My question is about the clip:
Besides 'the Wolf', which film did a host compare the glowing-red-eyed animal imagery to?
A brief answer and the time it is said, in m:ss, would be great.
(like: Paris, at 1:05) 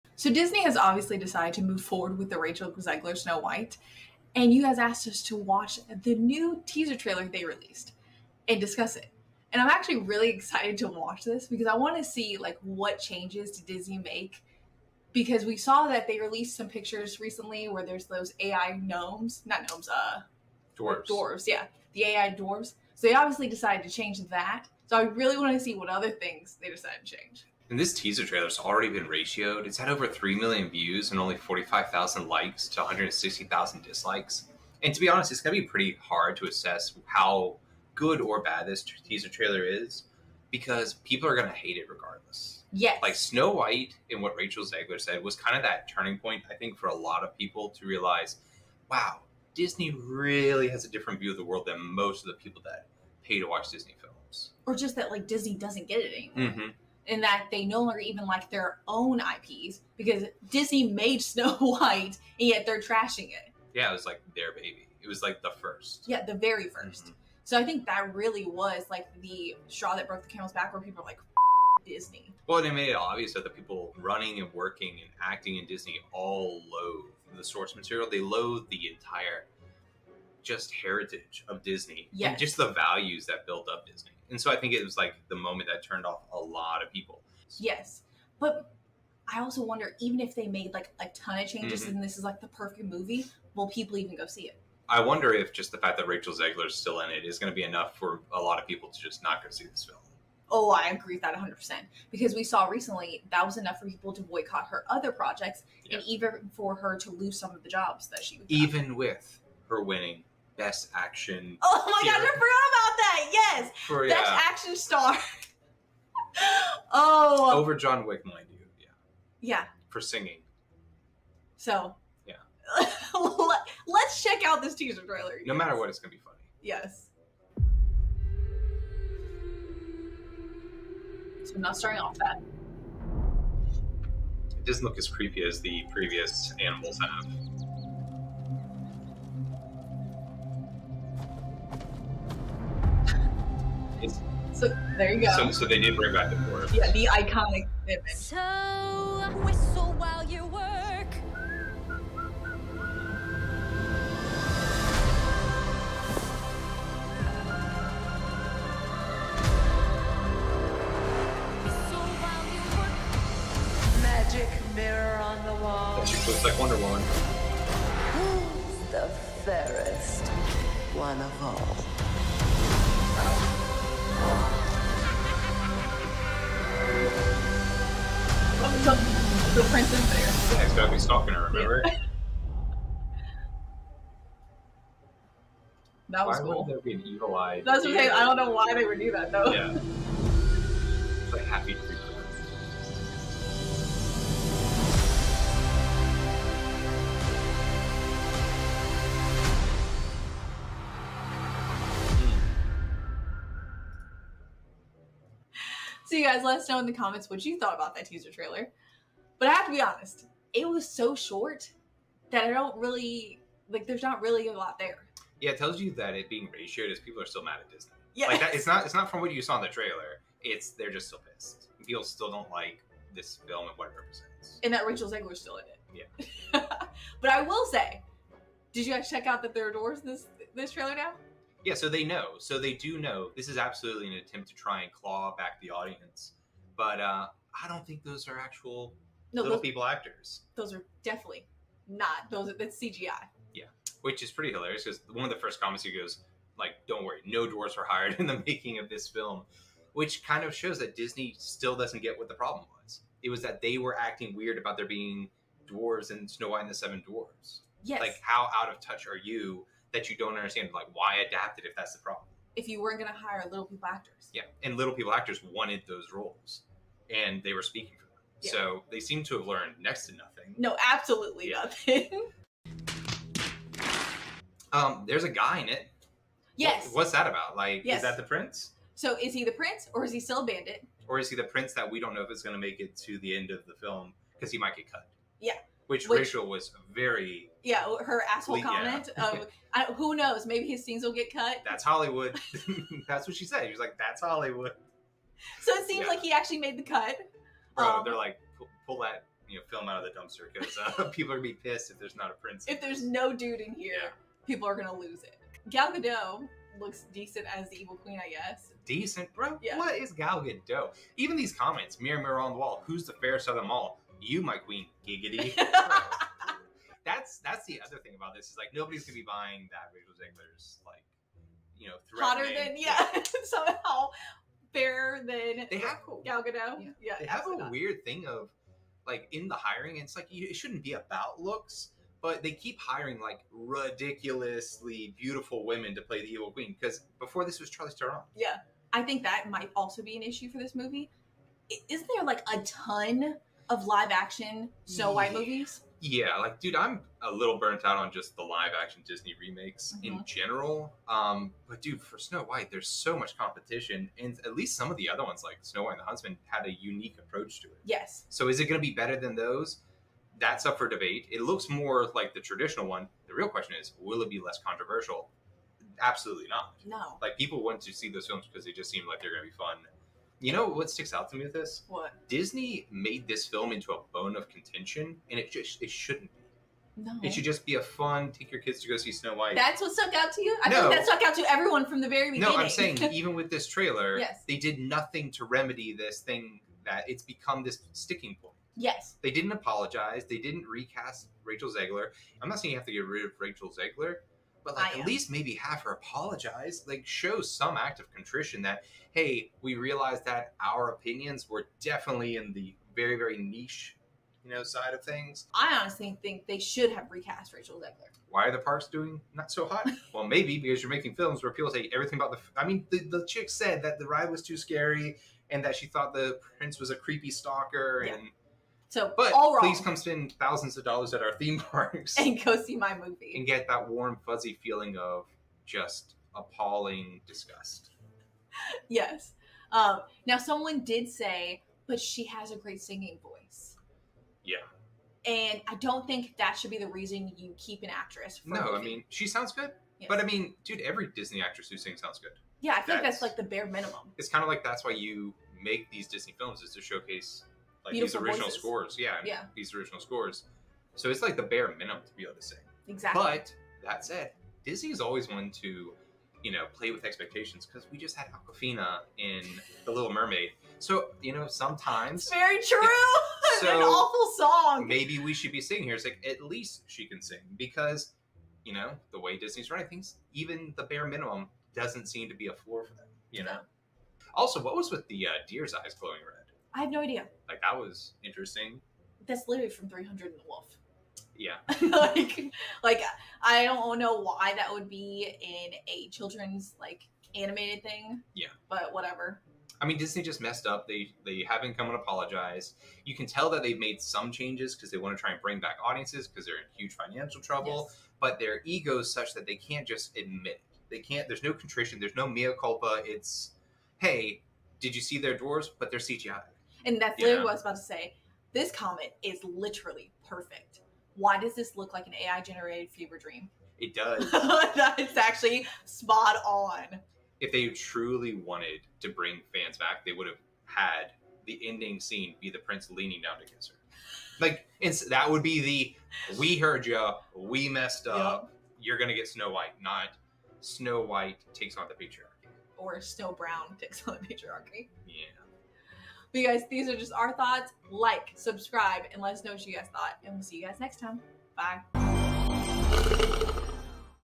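300, at 7:59.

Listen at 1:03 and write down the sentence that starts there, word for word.
Yeah, it was like their baby.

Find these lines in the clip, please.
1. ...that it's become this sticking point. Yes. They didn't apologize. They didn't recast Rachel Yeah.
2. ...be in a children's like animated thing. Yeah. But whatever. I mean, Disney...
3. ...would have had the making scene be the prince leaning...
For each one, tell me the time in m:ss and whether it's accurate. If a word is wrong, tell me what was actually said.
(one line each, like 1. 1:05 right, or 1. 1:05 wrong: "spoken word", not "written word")
1. 6:26 wrong: "Zegler", not "Yeah"
2. 8:04 right
3. 8:40 wrong: "ending", not "making".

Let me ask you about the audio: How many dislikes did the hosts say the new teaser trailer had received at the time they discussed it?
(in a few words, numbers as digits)
160,000.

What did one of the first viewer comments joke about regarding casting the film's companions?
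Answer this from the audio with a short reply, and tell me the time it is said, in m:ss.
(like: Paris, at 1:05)
No dwarves were hired, at 4:07.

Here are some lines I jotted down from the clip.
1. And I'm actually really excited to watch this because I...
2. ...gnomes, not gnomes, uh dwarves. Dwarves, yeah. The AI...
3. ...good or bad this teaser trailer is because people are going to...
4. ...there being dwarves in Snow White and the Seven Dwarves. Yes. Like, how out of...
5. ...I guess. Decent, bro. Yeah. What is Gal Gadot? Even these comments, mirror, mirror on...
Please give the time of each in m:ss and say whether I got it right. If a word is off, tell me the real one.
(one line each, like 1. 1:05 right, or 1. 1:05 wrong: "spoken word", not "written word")
1. 0:09 right
2. 0:18 right
3. 0:37 right
4. 4:14 right
5. 5:08 right.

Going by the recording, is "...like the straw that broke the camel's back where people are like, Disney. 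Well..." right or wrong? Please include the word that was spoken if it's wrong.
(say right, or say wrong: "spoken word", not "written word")
right.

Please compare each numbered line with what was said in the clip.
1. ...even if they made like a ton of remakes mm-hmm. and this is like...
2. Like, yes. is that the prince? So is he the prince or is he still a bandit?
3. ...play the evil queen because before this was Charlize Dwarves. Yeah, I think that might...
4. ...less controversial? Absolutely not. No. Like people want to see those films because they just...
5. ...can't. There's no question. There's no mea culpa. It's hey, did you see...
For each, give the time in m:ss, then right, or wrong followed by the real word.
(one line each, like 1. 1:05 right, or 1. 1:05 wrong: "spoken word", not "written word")
1. 1:29 wrong: "changes", not "remakes"
2. 4:37 right
3. 5:36 wrong: "Theron", not "Dwarves"
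4. 6:04 right
5. 8:20 wrong: "contrition", not "question".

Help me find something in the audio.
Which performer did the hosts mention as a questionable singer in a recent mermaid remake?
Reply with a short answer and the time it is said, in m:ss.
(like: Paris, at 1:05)
Awkwafina, at 7:38.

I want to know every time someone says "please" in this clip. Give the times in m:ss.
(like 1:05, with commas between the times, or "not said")
6:59.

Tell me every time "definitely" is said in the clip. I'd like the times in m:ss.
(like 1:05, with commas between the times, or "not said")
4:01, 6:41.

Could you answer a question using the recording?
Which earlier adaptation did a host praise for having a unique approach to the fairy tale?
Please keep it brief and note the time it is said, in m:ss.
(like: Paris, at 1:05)
Snow White and the Huntsman, at 5:55.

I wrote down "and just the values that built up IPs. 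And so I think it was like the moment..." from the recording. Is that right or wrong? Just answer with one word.
wrong.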